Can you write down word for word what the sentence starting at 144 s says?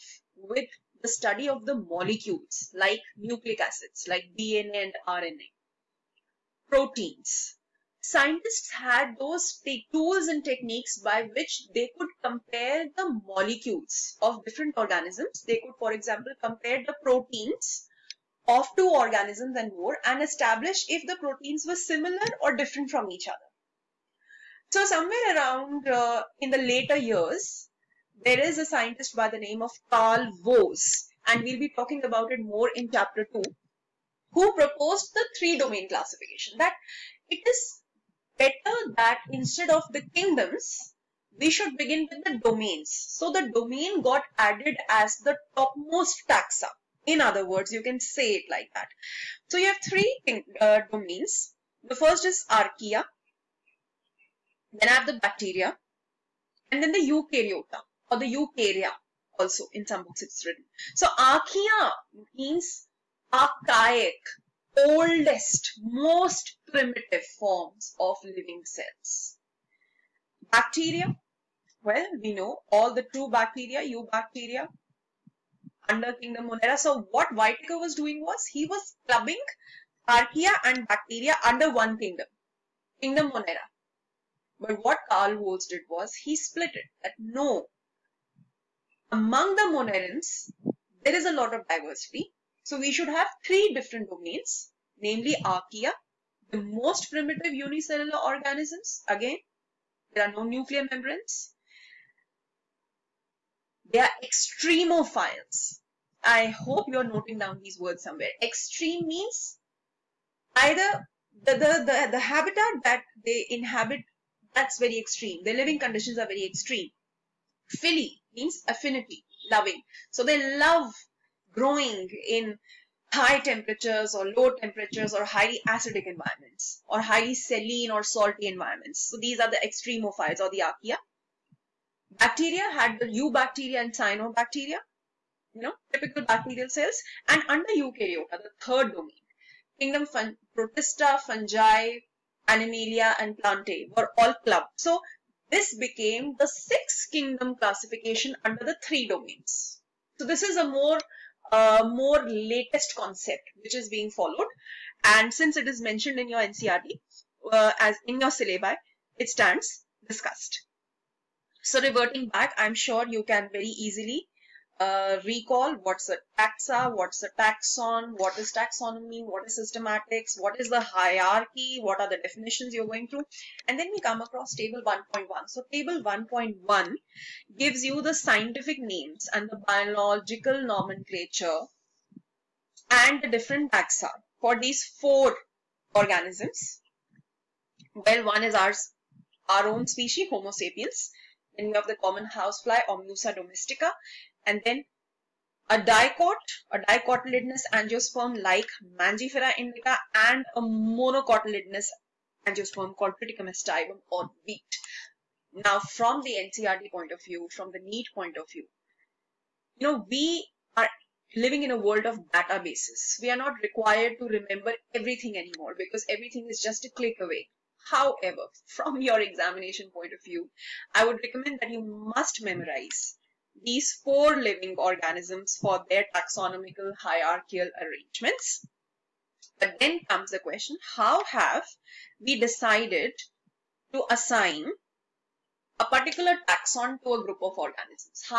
So this became the sixth kingdom classification under the three domains.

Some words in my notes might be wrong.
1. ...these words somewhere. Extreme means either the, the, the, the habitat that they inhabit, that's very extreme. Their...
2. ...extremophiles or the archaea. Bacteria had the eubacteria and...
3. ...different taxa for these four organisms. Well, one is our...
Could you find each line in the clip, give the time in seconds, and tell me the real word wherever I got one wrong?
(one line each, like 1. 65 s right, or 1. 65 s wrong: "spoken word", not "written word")
1. 107 s right
2. 129 s right
3. 183 s right.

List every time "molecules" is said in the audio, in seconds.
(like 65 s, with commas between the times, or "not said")
1 s, 13 s.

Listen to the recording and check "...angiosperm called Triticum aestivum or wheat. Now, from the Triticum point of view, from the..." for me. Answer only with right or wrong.
wrong.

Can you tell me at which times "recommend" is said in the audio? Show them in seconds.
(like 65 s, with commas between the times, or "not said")
221 s.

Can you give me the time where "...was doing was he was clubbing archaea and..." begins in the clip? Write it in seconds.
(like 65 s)
77 s.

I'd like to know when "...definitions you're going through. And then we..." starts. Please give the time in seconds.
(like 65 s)
172 s.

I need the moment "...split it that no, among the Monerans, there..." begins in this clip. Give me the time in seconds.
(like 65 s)
86 s.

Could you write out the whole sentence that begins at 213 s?
We are not required to remember everything anymore because everything is just a click away.